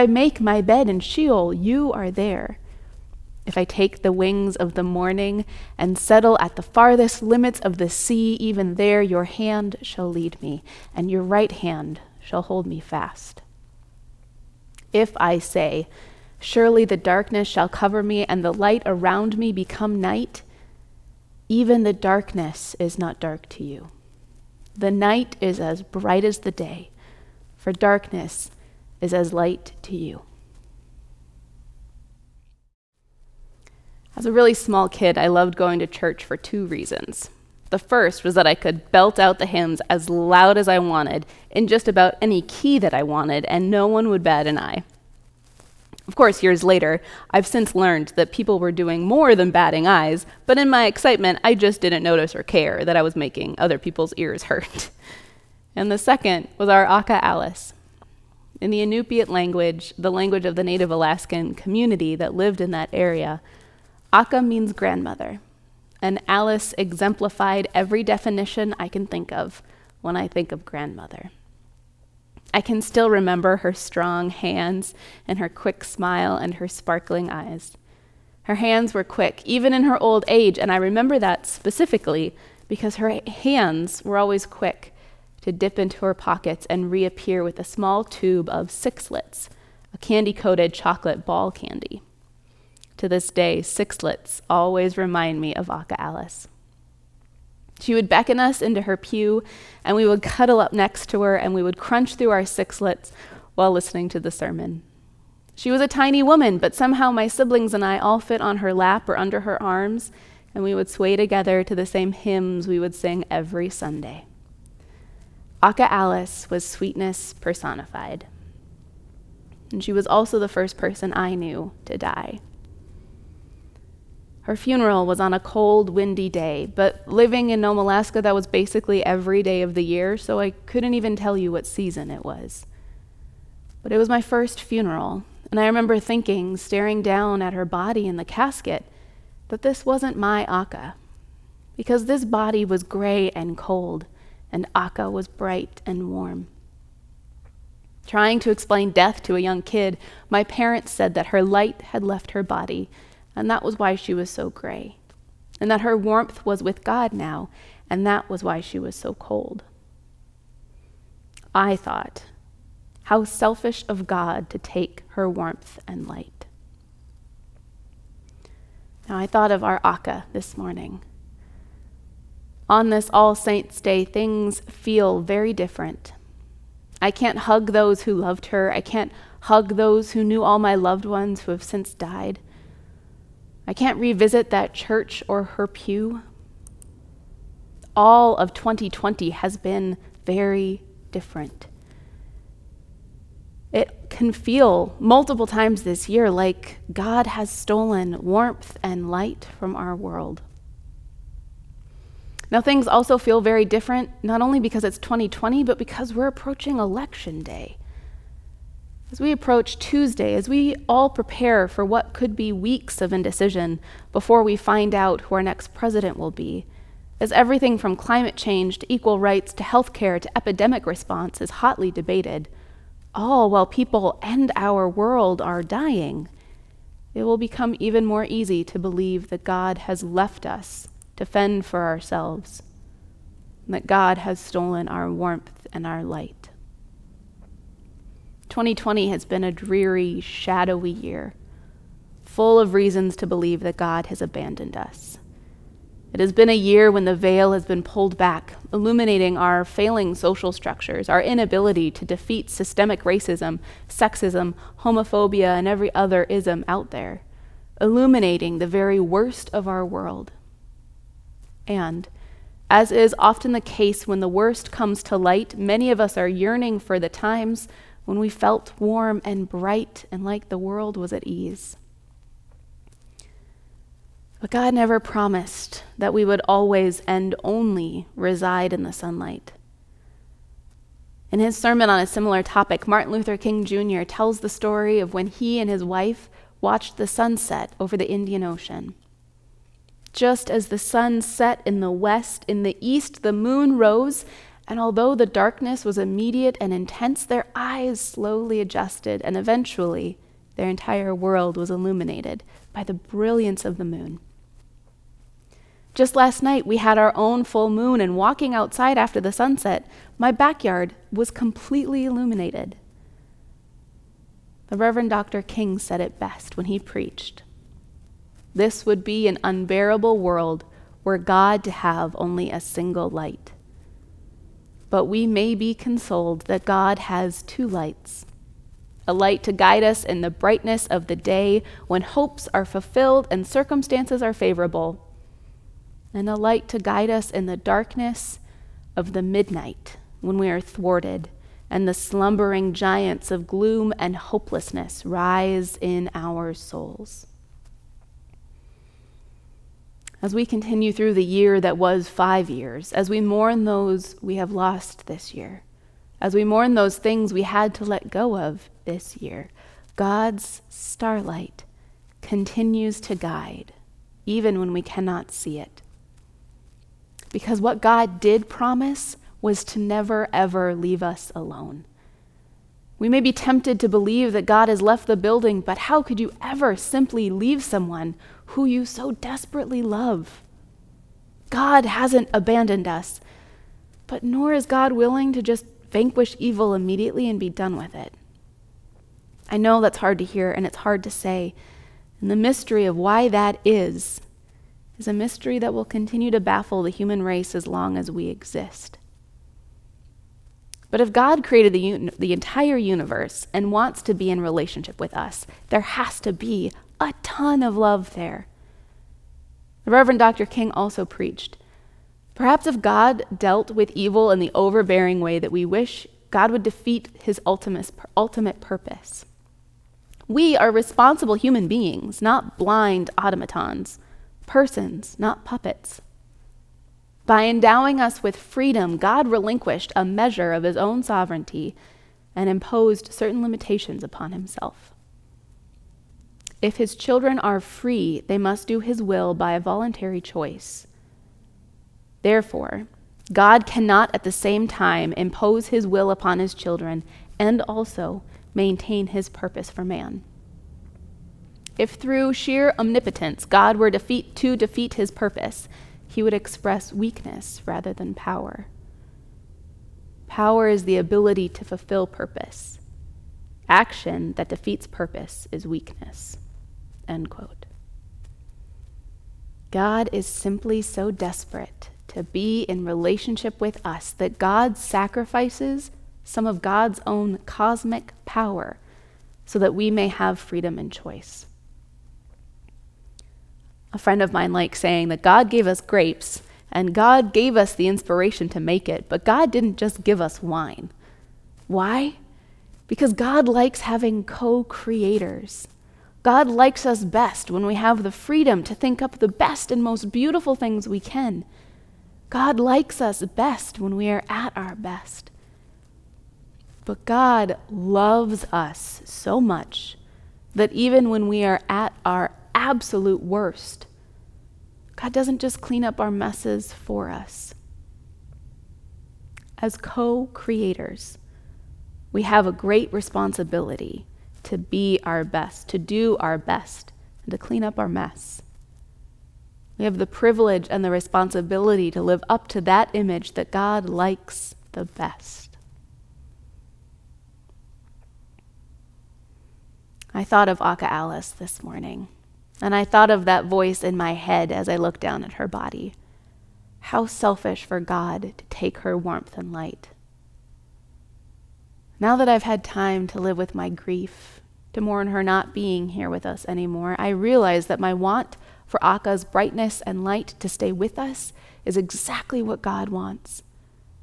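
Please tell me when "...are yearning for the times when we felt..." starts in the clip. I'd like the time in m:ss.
4:26.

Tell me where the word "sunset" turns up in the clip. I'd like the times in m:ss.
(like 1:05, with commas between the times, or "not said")
4:47, 5:09.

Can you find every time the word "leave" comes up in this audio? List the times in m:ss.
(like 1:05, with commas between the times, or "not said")
6:10, 6:17.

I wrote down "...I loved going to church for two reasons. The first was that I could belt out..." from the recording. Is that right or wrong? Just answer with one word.
right.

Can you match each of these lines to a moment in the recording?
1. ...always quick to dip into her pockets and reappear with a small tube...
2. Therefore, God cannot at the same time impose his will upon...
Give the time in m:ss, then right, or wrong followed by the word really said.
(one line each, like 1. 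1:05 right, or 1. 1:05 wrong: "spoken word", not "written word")
1. 1:24 right
2. 7:22 right.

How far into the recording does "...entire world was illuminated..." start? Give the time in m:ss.
5:00.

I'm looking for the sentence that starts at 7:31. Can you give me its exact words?
If through sheer omnipotence God were defeat, to defeat his purpose, he would express weakness rather than power.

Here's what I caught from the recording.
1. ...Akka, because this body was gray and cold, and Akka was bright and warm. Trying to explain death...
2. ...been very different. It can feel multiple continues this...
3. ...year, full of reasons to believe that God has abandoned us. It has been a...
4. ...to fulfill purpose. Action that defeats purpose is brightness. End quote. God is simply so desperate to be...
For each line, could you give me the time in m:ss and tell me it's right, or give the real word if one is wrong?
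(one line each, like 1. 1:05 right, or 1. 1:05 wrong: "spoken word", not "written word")
1. 2:20 right
2. 3:09 wrong: "times", not "continues"
3. 4:00 right
4. 7:41 wrong: "weakness", not "brightness".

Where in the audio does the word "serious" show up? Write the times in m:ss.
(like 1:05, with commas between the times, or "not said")
not said.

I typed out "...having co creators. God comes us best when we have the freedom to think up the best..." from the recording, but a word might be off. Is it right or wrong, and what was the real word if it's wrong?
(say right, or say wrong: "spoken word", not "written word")
wrong: "likes", not "comes".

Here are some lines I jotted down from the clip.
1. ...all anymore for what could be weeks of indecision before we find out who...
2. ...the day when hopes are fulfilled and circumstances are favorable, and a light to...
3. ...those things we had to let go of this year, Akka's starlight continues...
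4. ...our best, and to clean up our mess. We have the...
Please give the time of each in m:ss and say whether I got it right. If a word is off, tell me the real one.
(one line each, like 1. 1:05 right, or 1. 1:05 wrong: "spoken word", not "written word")
1. 3:30 wrong: "prepare", not "anymore"
2. 5:31 right
3. 5:56 wrong: "God", not "Akka"
4. 8:46 right.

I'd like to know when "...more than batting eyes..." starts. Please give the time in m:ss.
0:49.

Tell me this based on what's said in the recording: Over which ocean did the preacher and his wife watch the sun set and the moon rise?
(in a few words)
Indian Ocean.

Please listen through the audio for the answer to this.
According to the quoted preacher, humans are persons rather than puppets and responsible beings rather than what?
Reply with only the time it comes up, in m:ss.
7:02.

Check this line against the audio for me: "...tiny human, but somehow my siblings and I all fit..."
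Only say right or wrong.
wrong.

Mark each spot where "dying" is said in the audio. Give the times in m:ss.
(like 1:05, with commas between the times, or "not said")
3:45.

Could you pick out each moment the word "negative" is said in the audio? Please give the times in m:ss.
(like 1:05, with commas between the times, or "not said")
not said.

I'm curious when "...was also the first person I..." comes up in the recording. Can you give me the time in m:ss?
1:59.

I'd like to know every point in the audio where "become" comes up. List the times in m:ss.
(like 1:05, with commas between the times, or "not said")
0:19, 3:47.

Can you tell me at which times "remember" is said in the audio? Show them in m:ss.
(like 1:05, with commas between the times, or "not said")
1:13, 1:20, 2:15.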